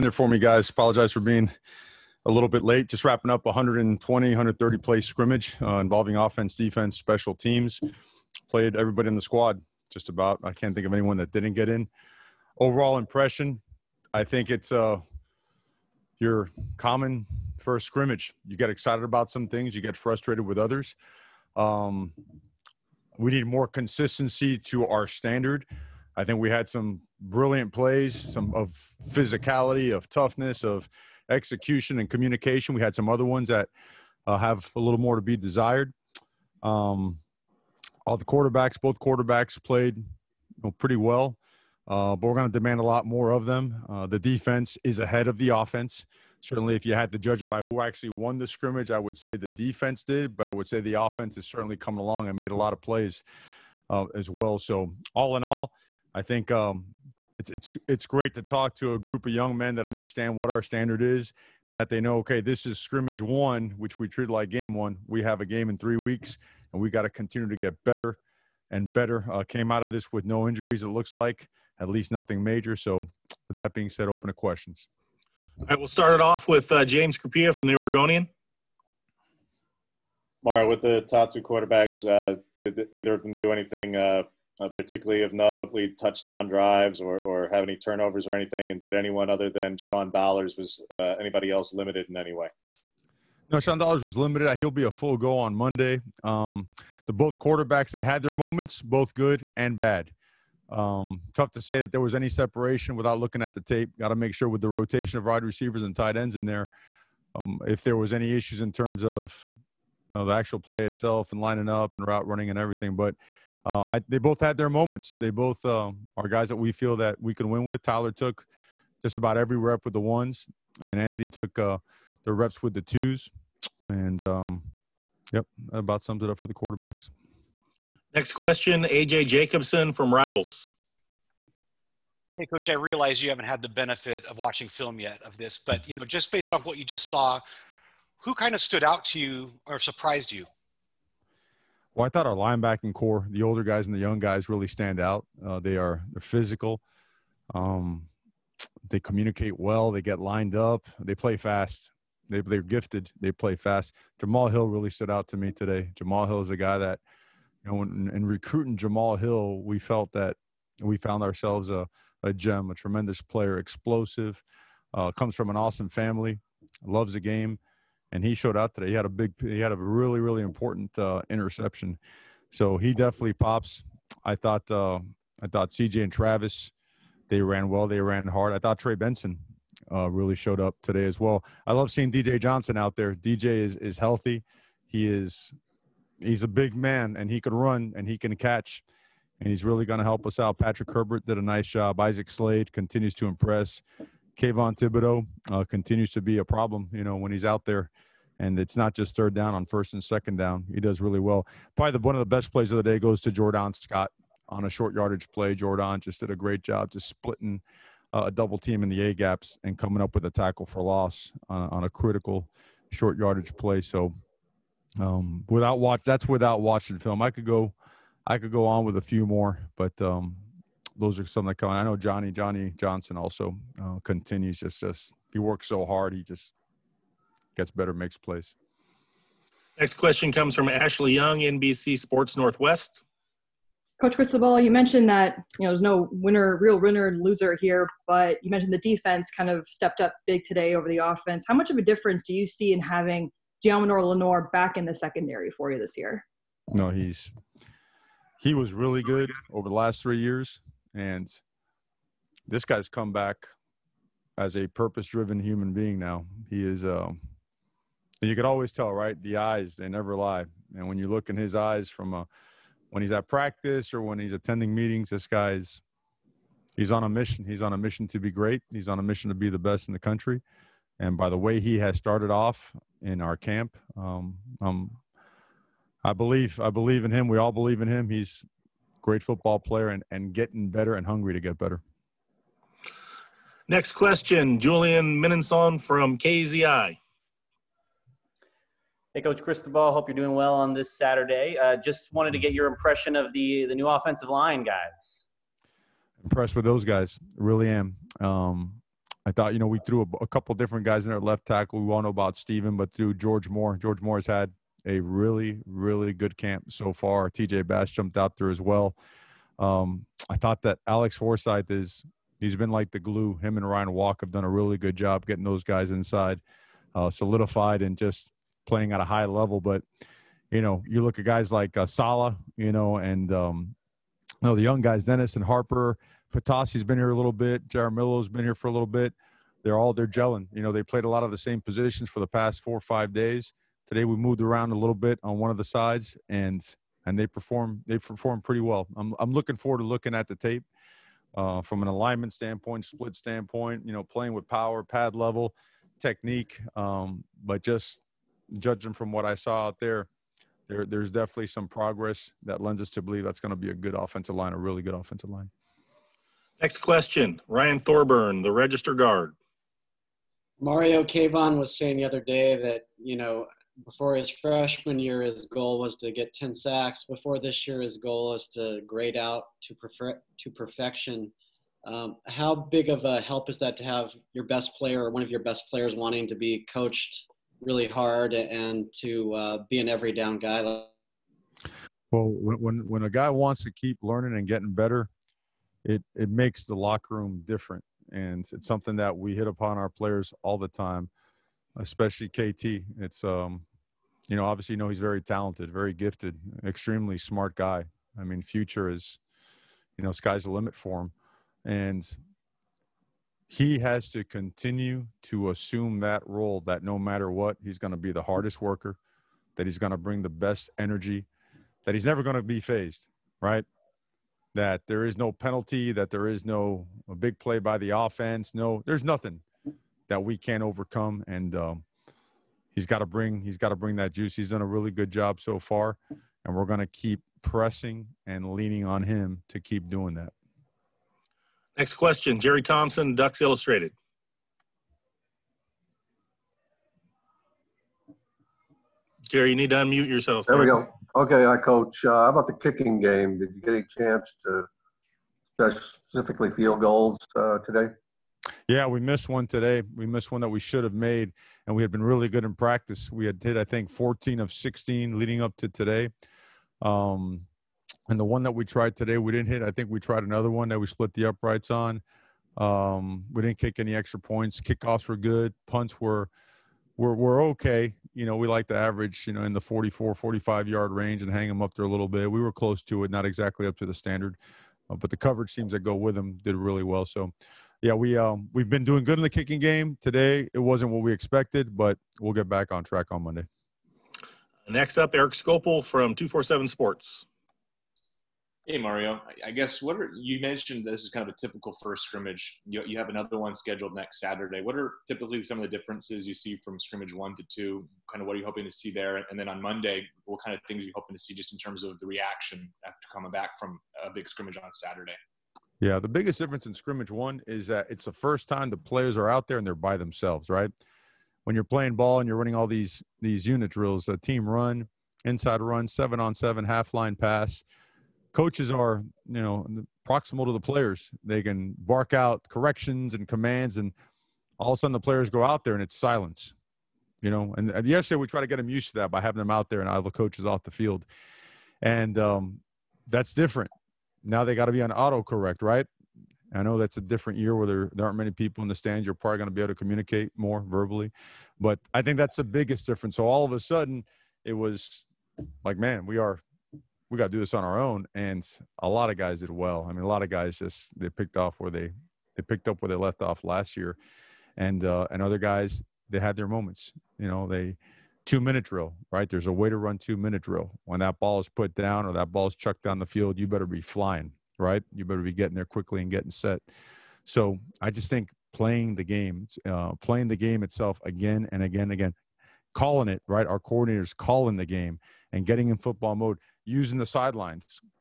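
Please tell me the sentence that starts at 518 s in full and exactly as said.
Coaches are, you know, proximal to the players.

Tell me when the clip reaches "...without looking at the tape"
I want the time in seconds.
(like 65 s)
102 s.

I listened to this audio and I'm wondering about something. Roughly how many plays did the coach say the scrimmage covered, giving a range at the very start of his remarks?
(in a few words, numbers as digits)
120, 130.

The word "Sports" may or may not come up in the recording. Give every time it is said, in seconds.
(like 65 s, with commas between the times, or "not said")
231 s, 486 s.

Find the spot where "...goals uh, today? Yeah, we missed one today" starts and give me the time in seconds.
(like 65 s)
446 s.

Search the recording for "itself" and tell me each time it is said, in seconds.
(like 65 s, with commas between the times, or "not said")
110 s, 570 s.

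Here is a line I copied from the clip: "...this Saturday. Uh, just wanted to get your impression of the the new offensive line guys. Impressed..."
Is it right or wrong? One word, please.
right.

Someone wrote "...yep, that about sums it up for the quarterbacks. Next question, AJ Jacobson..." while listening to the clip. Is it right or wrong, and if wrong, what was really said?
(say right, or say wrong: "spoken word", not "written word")
right.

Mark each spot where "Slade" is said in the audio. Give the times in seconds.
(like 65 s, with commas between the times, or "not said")
192 s.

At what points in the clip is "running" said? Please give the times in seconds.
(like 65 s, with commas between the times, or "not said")
112 s, 512 s.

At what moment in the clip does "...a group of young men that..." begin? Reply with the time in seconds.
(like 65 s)
58 s.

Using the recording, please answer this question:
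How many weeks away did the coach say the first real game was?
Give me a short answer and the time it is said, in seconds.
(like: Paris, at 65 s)
3, at 65 s.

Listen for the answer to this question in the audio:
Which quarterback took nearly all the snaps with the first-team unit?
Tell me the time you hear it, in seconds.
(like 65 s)
117 s.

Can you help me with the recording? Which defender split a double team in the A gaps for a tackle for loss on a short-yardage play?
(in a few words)
Jordan Scott.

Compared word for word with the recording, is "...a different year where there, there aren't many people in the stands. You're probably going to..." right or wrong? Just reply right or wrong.
right.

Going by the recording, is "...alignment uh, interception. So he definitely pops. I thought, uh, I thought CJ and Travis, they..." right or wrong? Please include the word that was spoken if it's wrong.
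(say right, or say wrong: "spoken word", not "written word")
wrong: "important", not "alignment".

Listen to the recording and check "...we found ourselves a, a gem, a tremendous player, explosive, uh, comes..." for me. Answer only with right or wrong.
right.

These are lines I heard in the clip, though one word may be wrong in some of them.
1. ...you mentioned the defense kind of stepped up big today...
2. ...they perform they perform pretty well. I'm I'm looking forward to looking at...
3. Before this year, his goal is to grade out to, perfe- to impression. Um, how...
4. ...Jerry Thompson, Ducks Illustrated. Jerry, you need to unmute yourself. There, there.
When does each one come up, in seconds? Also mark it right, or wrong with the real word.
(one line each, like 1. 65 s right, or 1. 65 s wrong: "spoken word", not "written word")
1. 238 s right
2. 337 s right
3. 367 s wrong: "perfection", not "impression"
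4. 432 s right.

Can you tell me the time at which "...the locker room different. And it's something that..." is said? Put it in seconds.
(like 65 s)
386 s.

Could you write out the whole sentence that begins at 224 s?
Just just he works so hard.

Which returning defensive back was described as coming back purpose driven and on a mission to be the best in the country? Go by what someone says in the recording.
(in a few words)
Deommodore Lenoir.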